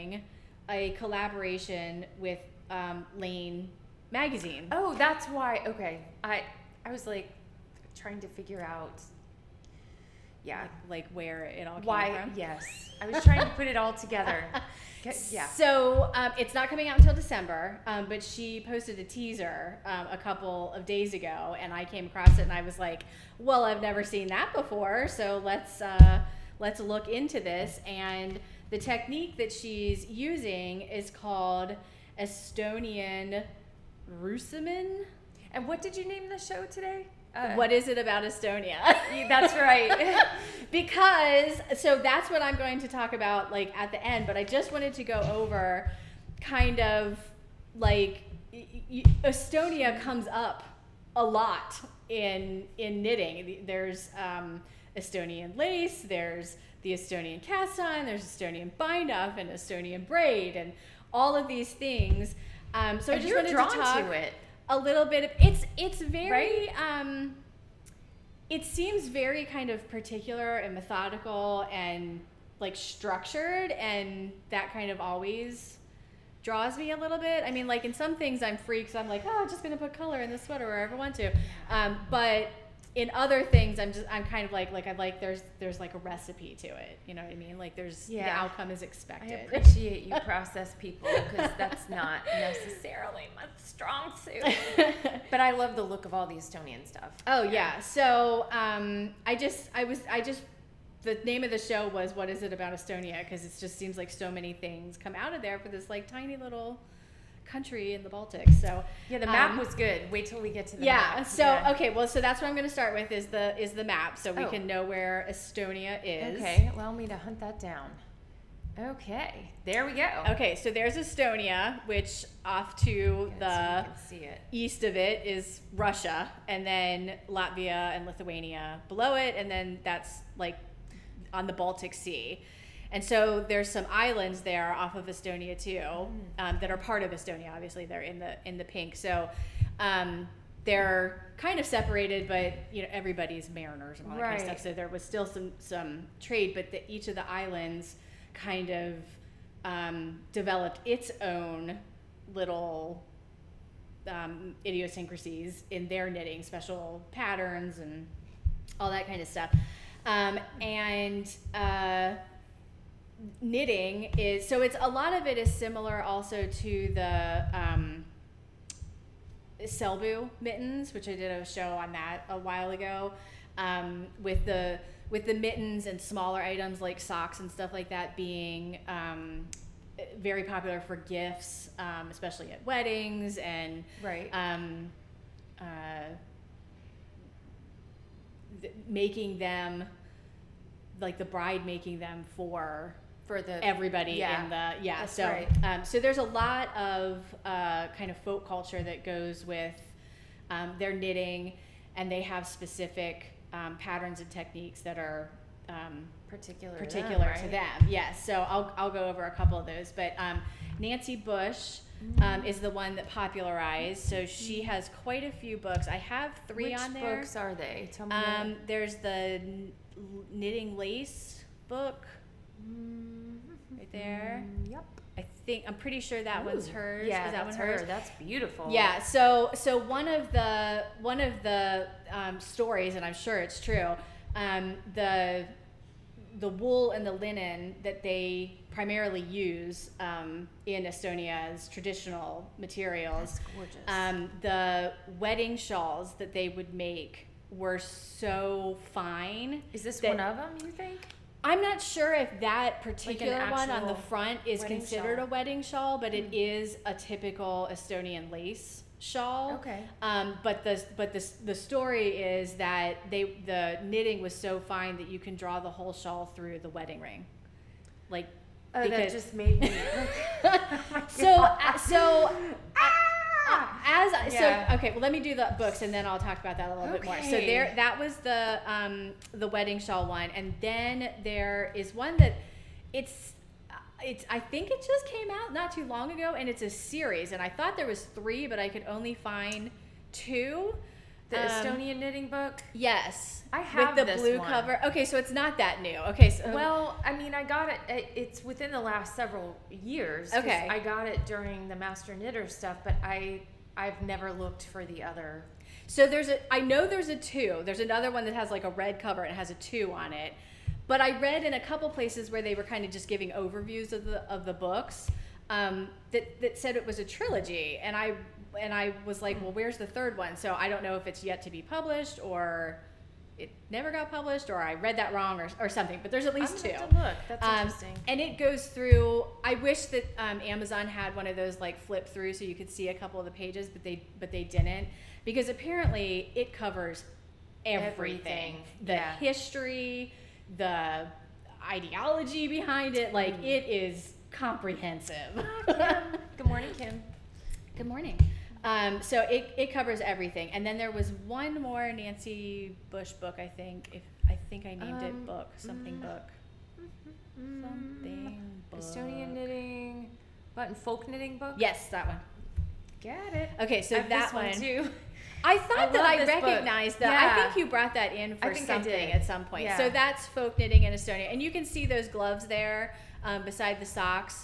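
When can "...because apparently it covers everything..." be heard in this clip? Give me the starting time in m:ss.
5:35.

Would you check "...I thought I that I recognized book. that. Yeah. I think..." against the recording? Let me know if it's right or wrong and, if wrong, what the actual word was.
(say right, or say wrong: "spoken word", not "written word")
right.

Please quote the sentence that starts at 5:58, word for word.
Estonian knitting, button folk knitting book?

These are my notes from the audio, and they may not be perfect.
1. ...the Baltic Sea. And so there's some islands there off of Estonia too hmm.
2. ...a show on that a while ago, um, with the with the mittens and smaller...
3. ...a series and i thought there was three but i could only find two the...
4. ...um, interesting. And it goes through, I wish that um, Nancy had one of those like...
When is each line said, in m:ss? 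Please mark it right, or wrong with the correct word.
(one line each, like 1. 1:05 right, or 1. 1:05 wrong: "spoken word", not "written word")
1. 2:11 right
2. 2:51 right
3. 4:46 right
4. 5:27 wrong: "Amazon", not "Nancy".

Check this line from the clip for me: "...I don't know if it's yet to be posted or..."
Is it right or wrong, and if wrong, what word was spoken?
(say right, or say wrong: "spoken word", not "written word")
wrong: "published", not "posted".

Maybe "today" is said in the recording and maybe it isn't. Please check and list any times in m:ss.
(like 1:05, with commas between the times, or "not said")
0:36.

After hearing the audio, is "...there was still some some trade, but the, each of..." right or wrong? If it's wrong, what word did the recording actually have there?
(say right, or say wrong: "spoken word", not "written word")
right.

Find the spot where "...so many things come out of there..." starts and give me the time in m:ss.
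1:44.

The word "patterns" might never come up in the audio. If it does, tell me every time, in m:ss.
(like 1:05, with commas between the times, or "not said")
2:37, 3:23.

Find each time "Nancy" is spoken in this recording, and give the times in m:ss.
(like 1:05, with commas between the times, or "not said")
3:30, 5:51.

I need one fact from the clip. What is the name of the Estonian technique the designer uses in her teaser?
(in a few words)
Estonian Roosimine.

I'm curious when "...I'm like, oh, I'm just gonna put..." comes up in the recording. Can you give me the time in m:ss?
1:18.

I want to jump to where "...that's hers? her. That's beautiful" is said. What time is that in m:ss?
3:47.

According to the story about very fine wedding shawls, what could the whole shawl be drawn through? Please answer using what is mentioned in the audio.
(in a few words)
The wedding ring.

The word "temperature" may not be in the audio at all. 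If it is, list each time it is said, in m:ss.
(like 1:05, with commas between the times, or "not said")
not said.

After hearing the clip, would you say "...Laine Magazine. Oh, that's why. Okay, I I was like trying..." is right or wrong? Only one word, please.
right.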